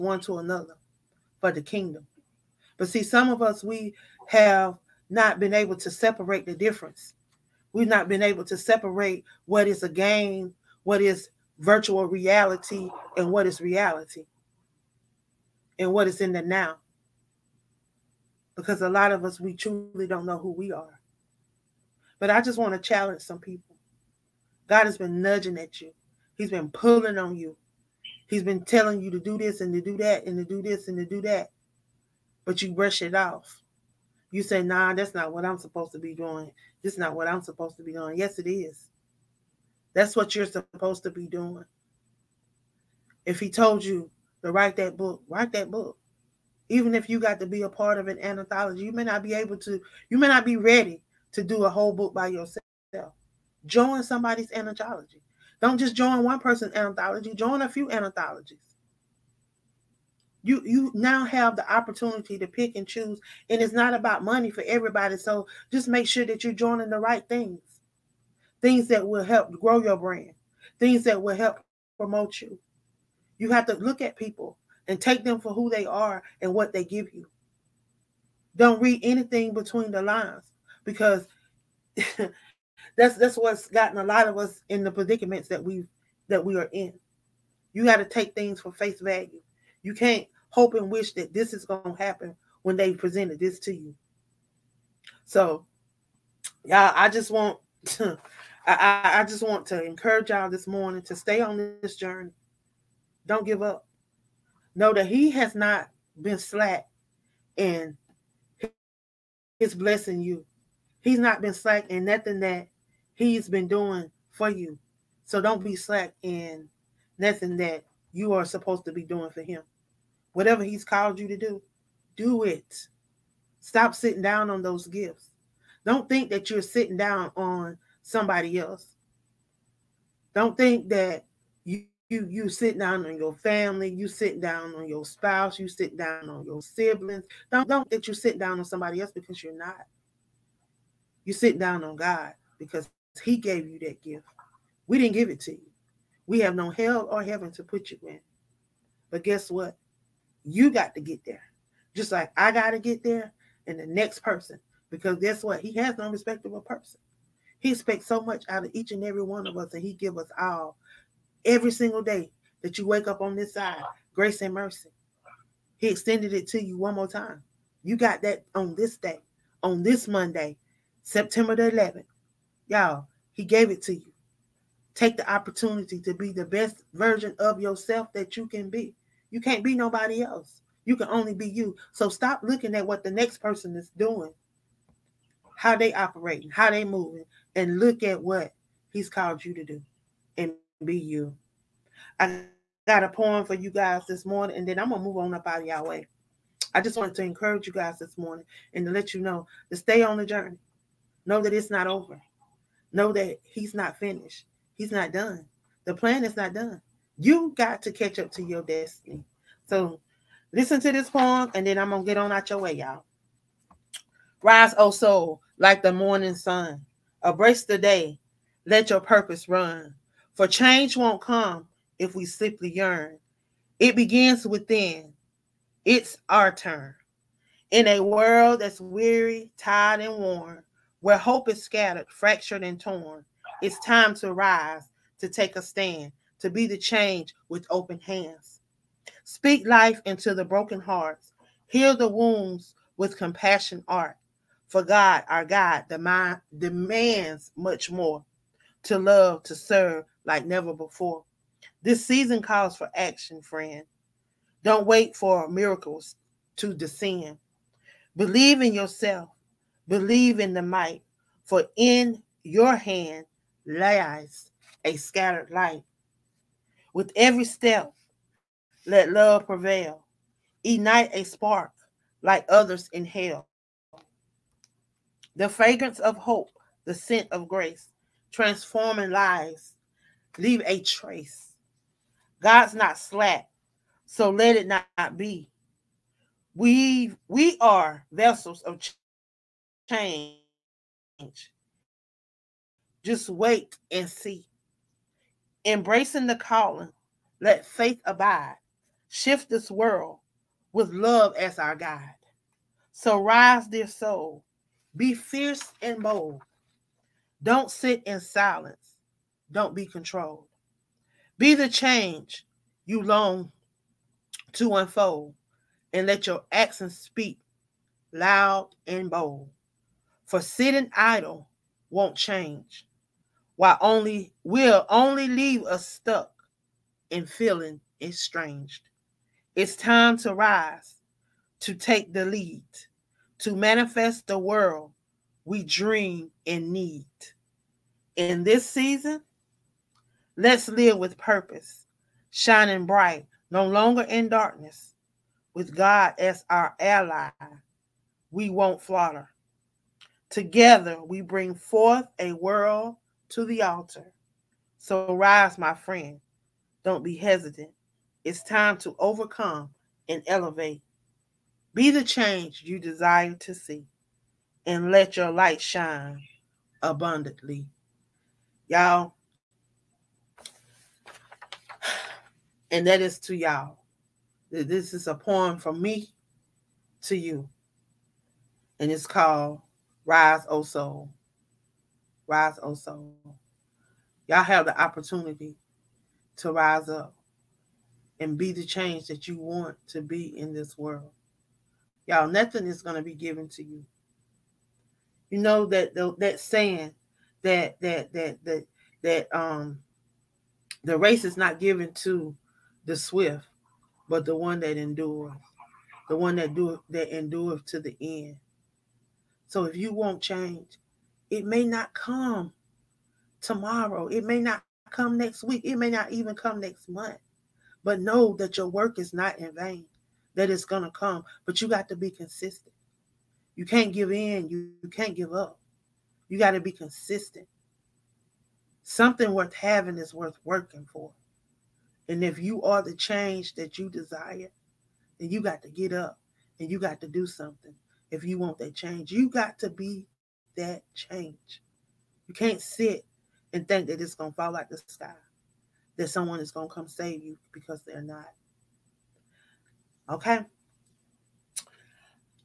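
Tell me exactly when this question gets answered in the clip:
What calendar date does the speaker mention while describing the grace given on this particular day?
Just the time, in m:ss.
2:51.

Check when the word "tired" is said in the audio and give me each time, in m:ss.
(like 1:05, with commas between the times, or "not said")
3:49.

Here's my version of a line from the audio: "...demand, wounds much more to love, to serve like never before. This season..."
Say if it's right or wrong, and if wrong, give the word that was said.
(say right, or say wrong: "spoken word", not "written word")
wrong: "demands", not "wounds".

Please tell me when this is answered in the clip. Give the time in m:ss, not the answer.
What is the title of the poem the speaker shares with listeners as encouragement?
6:20.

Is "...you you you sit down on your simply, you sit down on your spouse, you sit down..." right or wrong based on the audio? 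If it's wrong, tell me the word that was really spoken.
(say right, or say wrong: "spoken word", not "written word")
wrong: "family", not "simply".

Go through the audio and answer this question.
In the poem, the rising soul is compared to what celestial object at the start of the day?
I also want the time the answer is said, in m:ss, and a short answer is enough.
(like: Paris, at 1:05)
the morning sun, at 3:35.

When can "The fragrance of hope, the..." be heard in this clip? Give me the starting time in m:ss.
4:35.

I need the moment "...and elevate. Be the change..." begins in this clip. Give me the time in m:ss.
6:00.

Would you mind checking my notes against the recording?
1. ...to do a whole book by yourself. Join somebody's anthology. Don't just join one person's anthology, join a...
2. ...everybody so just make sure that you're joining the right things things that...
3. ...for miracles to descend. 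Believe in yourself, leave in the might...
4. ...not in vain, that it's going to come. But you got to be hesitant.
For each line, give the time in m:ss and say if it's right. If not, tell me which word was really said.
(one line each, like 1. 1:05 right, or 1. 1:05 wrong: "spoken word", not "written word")
1. 0:51 right
2. 1:04 right
3. 4:15 wrong: "believe", not "leave"
4. 6:59 wrong: "consistent", not "hesitant".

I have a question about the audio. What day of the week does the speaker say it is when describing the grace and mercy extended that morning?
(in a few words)
Monday.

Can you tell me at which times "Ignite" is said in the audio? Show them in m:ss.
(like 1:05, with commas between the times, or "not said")
4:30.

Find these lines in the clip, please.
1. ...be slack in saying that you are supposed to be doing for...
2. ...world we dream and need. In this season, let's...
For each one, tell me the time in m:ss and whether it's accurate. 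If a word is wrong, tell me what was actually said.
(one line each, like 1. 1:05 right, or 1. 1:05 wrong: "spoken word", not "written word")
1. 1:55 wrong: "nothing", not "saying"
2. 5:34 right.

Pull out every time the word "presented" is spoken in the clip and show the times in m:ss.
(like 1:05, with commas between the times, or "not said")
1:32.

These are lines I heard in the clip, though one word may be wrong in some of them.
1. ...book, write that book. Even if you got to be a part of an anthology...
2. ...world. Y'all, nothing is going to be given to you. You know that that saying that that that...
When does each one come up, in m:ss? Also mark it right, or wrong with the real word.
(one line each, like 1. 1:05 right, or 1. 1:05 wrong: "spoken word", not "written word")
1. 0:44 right
2. 6:30 right.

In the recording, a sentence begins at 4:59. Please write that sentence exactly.
Shift this world with love as our guide.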